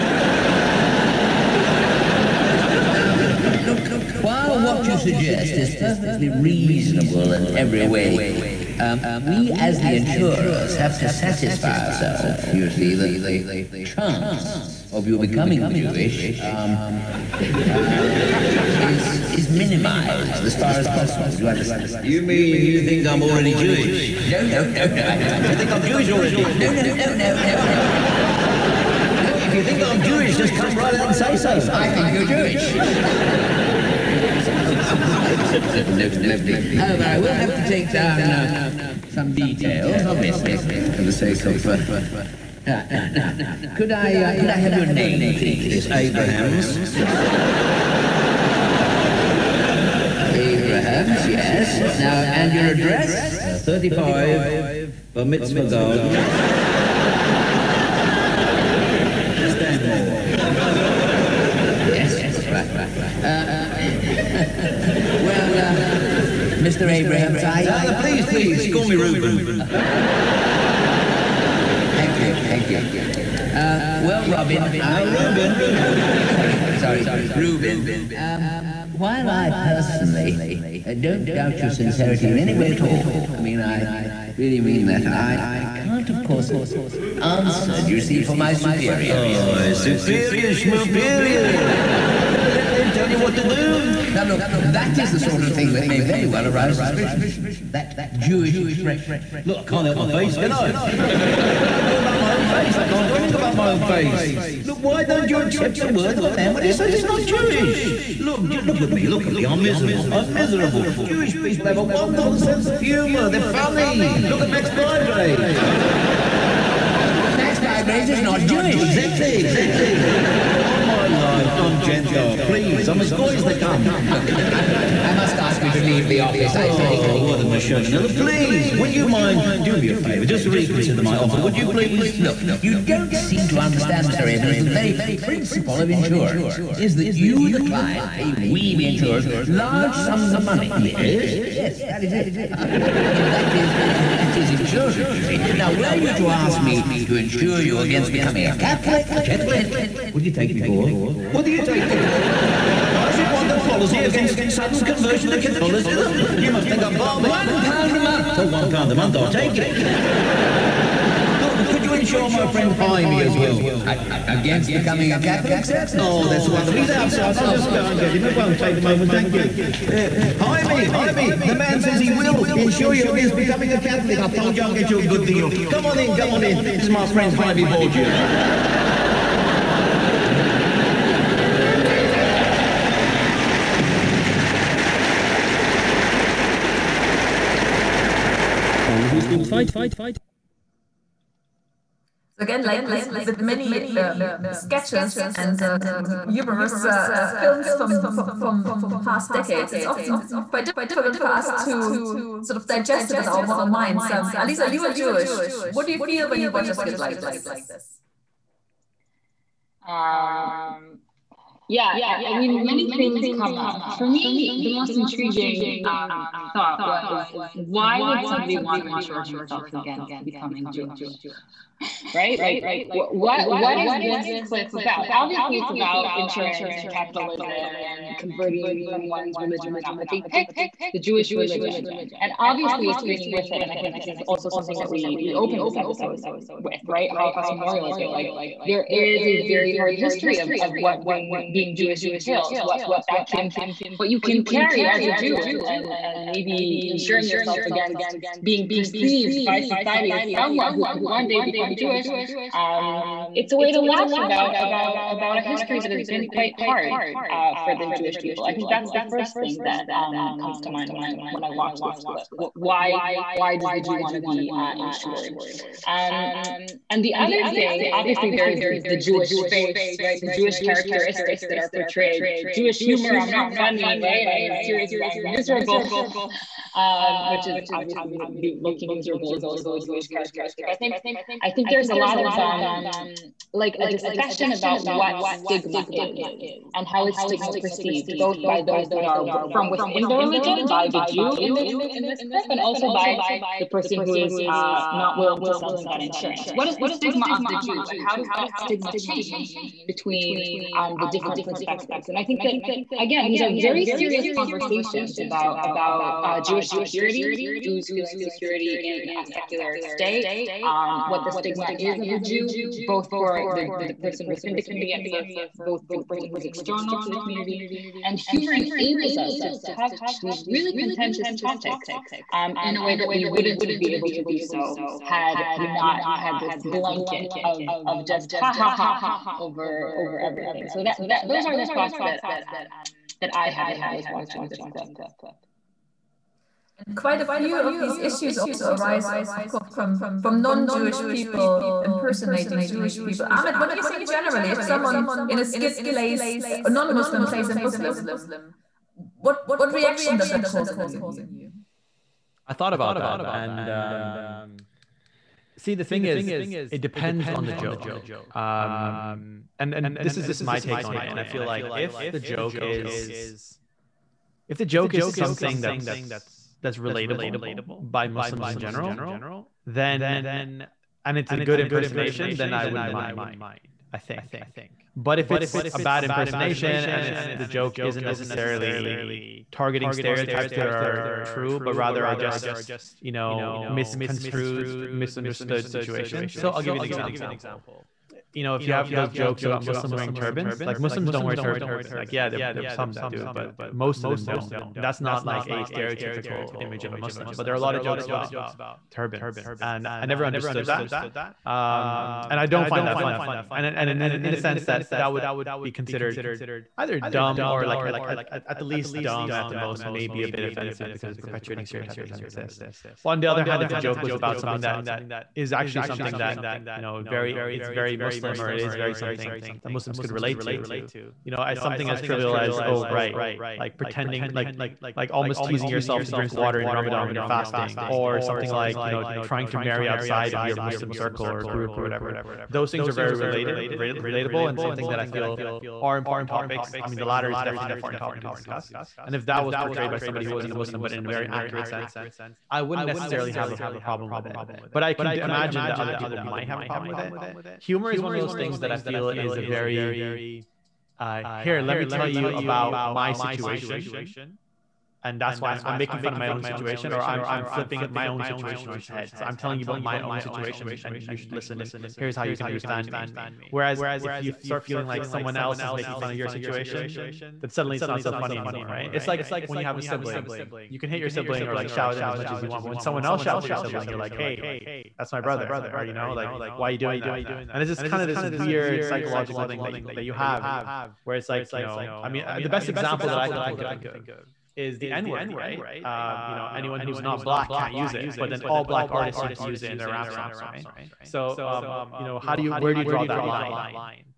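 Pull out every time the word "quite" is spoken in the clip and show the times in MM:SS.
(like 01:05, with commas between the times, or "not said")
03:20, 04:16, 05:36.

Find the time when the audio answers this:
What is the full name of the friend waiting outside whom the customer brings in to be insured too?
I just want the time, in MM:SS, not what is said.
02:57.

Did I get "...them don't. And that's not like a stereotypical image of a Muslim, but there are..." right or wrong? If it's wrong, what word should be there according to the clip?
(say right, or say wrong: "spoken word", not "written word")
right.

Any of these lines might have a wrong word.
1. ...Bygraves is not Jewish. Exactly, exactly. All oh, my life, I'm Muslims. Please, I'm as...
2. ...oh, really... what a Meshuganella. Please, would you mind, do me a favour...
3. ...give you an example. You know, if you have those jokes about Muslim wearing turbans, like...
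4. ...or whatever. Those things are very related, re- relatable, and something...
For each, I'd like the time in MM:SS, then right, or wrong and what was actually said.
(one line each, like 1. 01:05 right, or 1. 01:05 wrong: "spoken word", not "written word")
1. 01:57 wrong: "Gentile", not "Muslims"
2. 02:06 right
3. 06:26 right
4. 07:11 right.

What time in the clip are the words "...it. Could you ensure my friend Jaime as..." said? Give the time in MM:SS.
02:39.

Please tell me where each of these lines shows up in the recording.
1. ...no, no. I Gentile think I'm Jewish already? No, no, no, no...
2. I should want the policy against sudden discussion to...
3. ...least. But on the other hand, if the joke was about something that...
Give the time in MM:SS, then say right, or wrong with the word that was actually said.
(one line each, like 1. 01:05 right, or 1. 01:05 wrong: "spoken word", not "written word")
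1. 00:24 wrong: "You", not "Gentile"
2. 02:33 wrong: "conversion", not "discussion"
3. 06:52 wrong: "exist", not "least".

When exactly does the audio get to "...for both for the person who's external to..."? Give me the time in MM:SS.
05:15.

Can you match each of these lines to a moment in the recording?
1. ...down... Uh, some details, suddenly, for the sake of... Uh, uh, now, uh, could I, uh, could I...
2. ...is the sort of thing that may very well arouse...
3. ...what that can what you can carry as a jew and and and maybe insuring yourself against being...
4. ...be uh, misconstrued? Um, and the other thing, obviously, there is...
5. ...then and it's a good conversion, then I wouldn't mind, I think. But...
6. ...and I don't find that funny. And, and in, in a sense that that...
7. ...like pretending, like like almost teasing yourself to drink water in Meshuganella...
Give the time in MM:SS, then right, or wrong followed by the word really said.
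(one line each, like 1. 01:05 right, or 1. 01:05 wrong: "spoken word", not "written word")
1. 00:37 wrong: "obviously", not "suddenly"
2. 01:34 right
3. 04:02 right
4. 04:24 wrong: "insured", not "misconstrued"
5. 06:09 wrong: "impersonation", not "conversion"
6. 06:42 right
7. 07:03 wrong: "Ramadan", not "Meshuganella".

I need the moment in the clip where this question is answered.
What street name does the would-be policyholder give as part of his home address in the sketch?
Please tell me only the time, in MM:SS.
00:55.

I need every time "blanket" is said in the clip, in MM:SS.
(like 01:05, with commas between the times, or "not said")
05:26.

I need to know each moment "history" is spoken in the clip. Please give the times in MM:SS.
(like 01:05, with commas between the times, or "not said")
03:59, 04:15.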